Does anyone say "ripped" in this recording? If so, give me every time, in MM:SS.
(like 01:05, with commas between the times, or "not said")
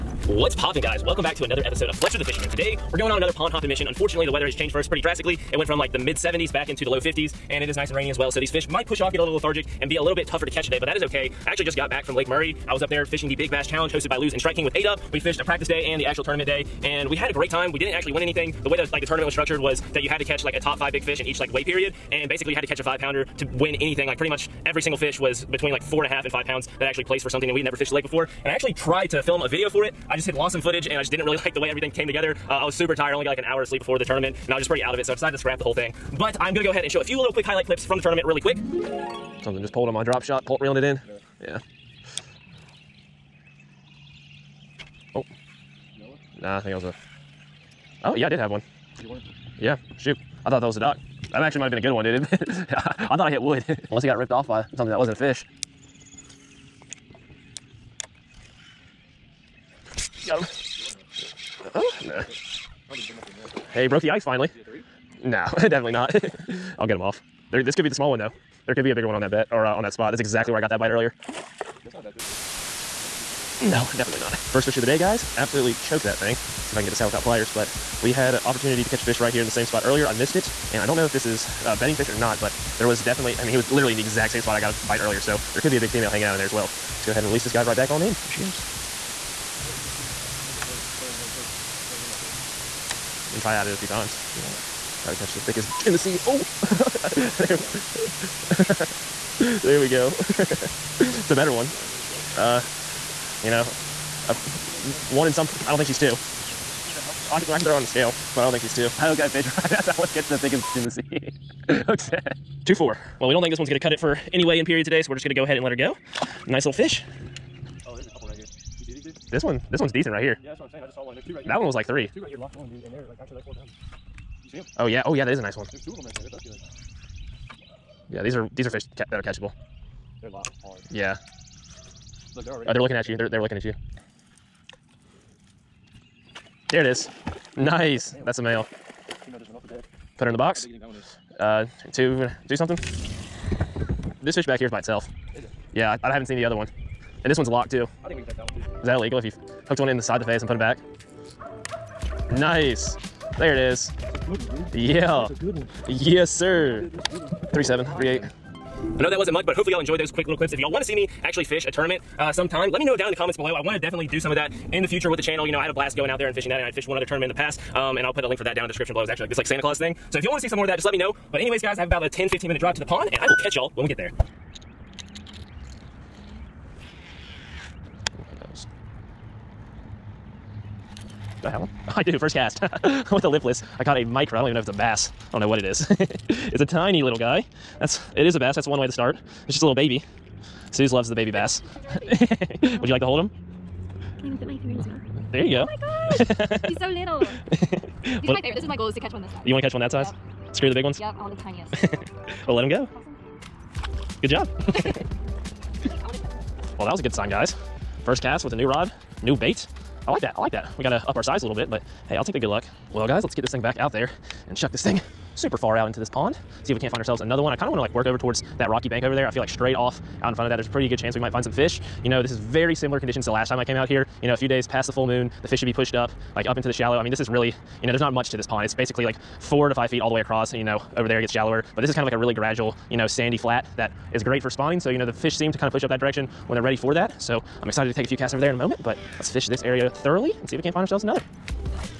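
00:54.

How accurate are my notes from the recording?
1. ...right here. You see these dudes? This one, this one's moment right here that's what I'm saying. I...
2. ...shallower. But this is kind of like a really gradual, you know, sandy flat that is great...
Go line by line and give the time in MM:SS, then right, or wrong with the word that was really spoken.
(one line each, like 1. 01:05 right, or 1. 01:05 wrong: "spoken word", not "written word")
1. 01:58 wrong: "decent", not "moment"
2. 03:51 right.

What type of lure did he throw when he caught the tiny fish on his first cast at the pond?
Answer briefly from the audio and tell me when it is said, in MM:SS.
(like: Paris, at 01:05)
lipless, at 03:03.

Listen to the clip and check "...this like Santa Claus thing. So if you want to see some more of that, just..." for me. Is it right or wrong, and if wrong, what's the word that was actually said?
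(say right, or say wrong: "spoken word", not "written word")
right.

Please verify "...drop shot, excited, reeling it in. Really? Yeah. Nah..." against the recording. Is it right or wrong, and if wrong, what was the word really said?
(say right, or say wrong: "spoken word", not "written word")
wrong: "pulled", not "excited".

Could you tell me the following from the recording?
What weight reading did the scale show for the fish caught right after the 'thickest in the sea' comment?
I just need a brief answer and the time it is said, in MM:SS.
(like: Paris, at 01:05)
2 4, at 01:52.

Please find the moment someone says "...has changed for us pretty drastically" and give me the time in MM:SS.
00:04.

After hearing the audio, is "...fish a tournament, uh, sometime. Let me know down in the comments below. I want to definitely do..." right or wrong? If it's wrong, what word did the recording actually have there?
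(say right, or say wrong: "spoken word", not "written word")
right.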